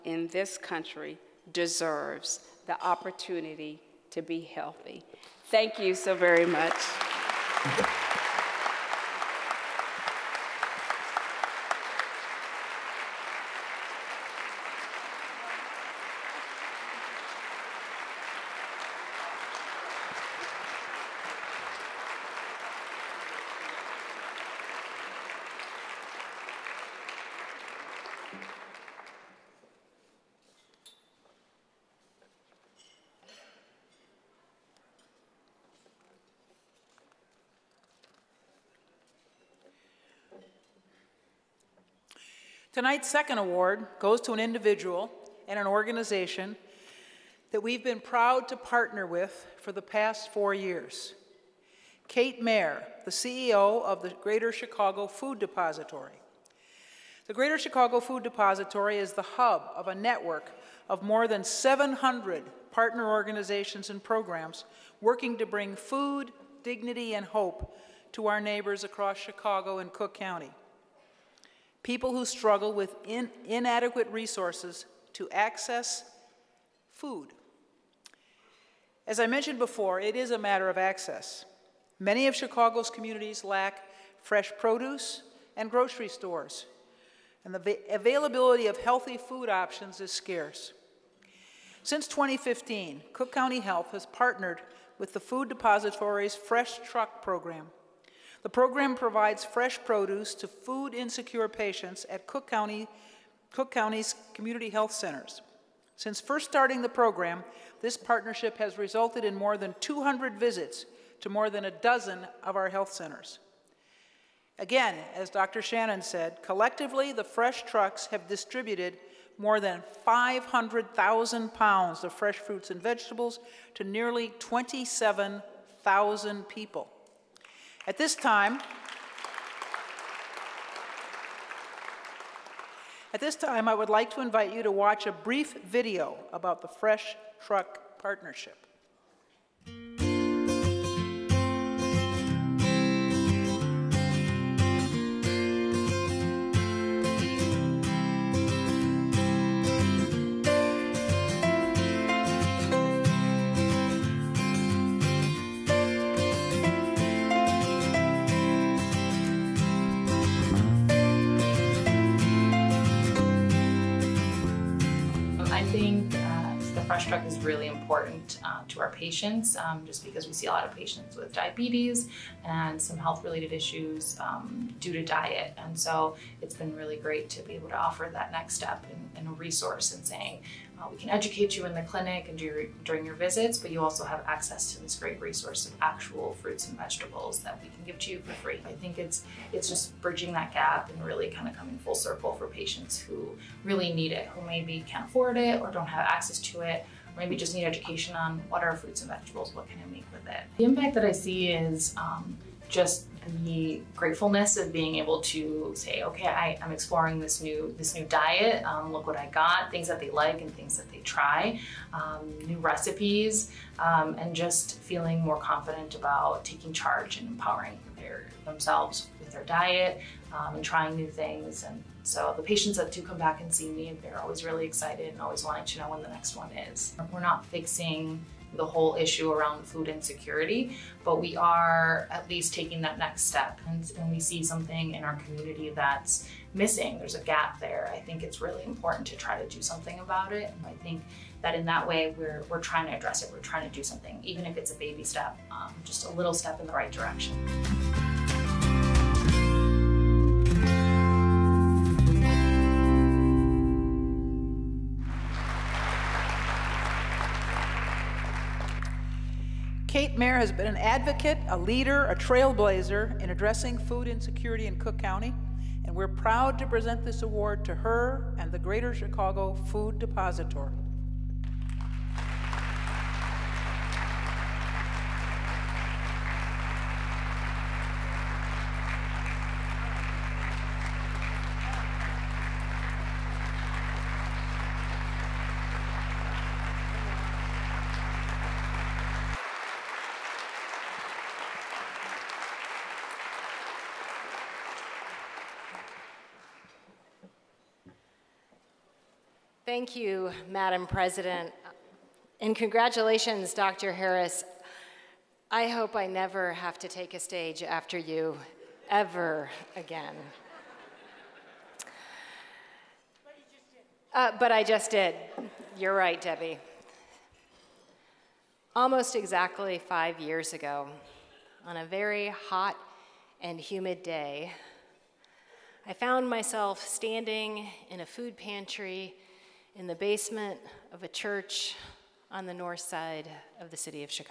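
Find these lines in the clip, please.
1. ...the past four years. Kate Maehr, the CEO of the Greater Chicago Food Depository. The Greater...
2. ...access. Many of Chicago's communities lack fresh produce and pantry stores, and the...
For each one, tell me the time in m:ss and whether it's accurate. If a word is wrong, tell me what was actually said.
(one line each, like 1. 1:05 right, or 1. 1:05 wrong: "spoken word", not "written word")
1. 0:49 right
2. 1:20 wrong: "grocery", not "pantry".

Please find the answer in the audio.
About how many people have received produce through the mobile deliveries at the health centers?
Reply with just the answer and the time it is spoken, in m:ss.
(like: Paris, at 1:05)
nearly 27,000, at 2:03.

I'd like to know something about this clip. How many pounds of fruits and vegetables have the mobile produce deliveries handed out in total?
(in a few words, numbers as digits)
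more than 500,000.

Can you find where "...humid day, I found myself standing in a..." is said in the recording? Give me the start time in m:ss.
5:23.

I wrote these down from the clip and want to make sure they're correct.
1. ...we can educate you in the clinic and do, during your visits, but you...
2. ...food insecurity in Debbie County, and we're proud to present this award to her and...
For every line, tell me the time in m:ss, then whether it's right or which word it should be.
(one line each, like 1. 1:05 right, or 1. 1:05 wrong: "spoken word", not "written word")
1. 3:00 right
2. 4:23 wrong: "Cook", not "Debbie".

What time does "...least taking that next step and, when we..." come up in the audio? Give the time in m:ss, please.
3:52.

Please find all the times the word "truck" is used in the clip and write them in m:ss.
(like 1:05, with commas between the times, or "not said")
1:36, 1:57, 2:17.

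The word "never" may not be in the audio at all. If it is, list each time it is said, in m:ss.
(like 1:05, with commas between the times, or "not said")
5:06.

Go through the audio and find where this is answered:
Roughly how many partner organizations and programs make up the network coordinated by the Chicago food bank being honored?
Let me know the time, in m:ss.
1:01.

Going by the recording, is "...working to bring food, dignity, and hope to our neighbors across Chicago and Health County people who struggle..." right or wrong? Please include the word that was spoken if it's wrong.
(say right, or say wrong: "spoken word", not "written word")
wrong: "Cook", not "Health".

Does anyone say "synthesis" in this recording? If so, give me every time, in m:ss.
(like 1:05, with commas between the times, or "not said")
not said.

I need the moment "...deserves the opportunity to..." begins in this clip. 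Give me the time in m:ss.
0:01.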